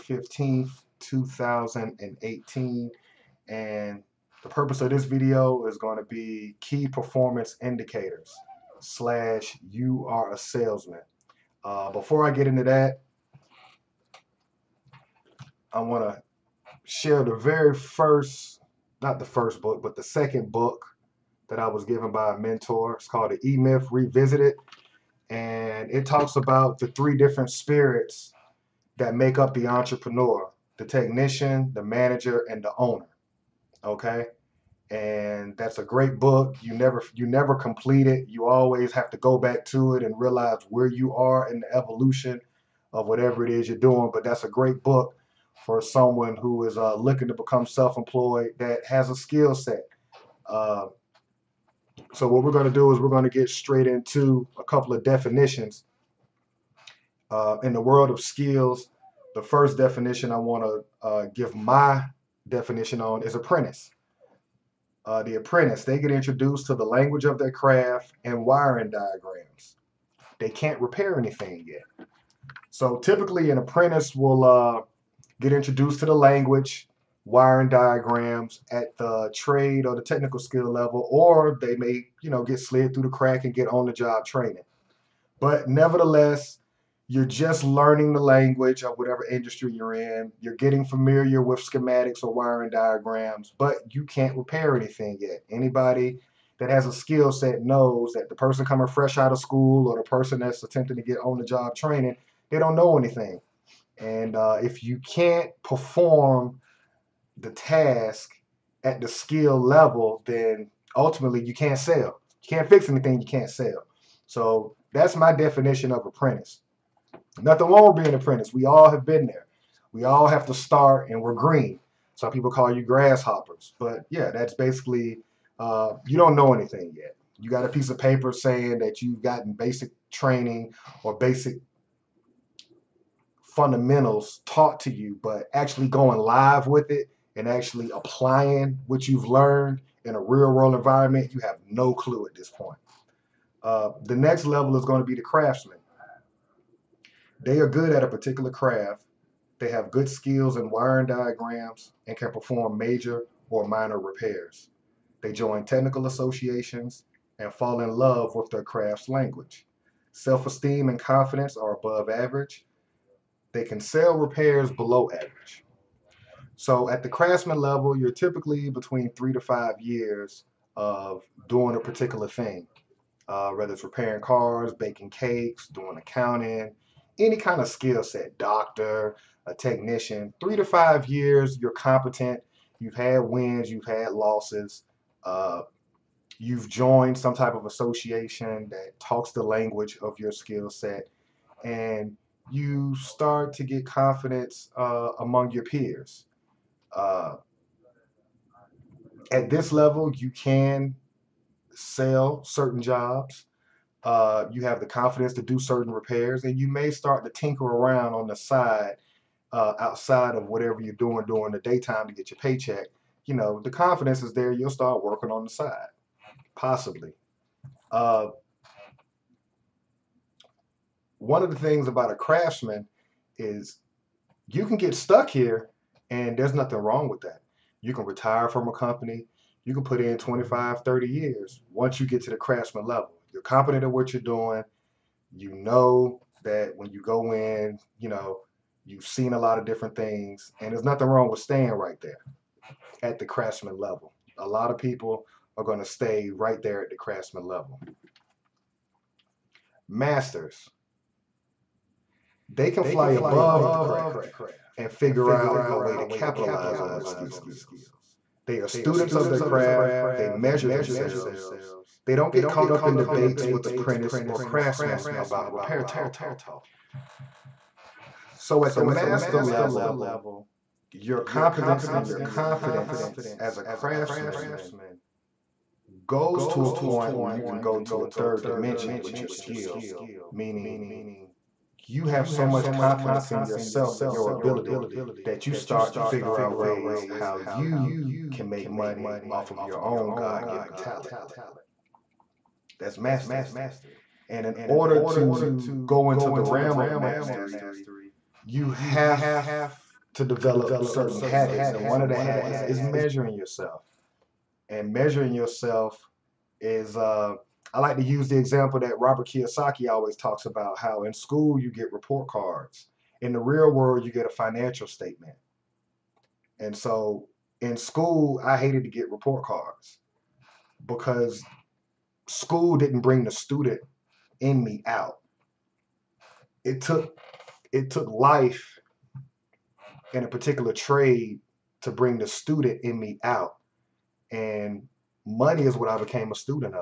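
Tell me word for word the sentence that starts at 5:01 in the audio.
And one of the habits is measuring yourself.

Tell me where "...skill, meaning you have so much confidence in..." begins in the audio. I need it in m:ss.
4:39.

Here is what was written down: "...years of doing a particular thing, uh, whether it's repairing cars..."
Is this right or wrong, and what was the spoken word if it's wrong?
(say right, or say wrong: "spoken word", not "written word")
right.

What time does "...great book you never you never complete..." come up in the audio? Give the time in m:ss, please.
0:35.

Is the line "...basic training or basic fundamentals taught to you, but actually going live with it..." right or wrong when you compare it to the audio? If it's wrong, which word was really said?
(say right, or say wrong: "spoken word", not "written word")
right.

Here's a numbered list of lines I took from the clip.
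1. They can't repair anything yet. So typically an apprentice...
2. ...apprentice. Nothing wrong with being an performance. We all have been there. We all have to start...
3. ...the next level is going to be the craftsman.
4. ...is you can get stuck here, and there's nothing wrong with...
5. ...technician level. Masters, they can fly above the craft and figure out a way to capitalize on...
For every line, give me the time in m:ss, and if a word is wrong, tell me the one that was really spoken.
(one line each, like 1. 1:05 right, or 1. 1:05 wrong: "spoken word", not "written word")
1. 1:10 right
2. 1:56 wrong: "apprentice", not "performance"
3. 2:24 right
4. 3:43 right
5. 4:06 wrong: "craftsman", not "technician".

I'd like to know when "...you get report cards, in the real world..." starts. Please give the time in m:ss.
5:11.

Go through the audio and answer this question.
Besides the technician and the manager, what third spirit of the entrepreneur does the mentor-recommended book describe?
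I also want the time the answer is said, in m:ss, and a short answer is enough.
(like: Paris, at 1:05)
the owner, at 0:32.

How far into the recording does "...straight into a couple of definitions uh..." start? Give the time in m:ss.
0:53.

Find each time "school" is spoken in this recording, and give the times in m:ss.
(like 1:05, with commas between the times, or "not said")
1:39, 5:11, 5:17, 5:22.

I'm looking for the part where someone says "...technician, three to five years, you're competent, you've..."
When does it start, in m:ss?
2:59.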